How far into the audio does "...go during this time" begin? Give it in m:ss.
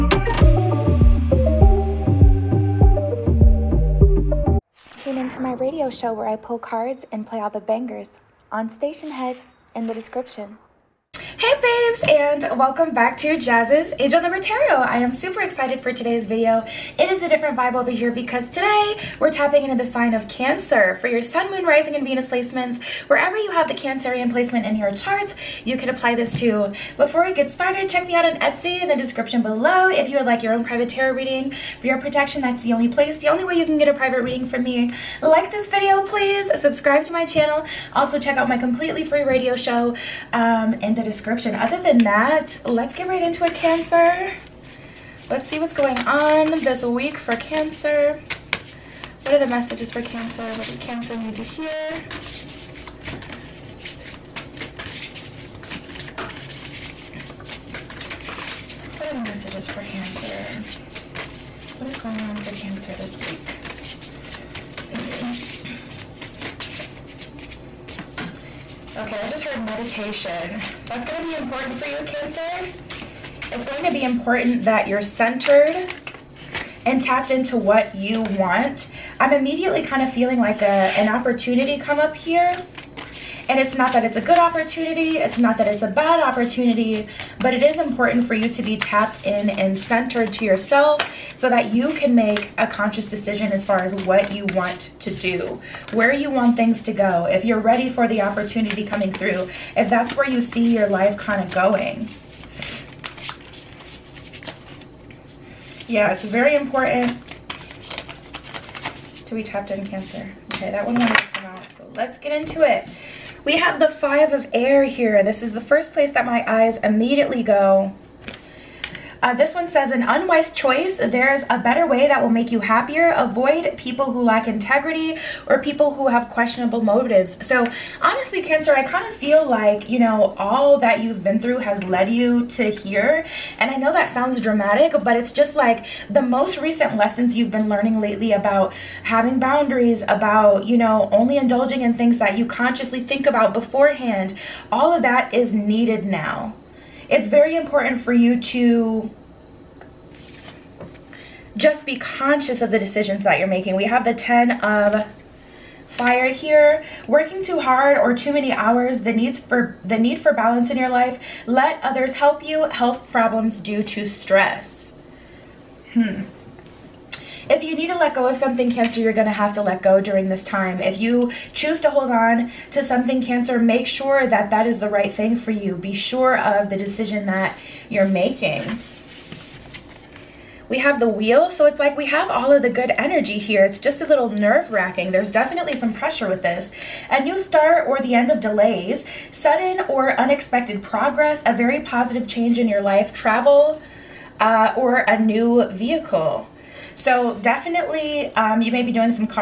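2:49.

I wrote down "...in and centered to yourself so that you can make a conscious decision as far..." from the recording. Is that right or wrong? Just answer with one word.
right.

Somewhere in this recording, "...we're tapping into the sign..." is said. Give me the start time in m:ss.
0:19.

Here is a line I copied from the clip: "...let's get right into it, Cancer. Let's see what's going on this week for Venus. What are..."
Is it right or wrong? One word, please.
wrong.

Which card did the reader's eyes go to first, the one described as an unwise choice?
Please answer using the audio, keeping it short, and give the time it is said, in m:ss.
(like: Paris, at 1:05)
Five of Air, at 1:53.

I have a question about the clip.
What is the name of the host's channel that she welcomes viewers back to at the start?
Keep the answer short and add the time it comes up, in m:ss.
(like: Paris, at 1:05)
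Jazz's Angel Number Tarot, at 0:13.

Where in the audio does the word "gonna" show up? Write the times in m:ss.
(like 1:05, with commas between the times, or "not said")
1:11.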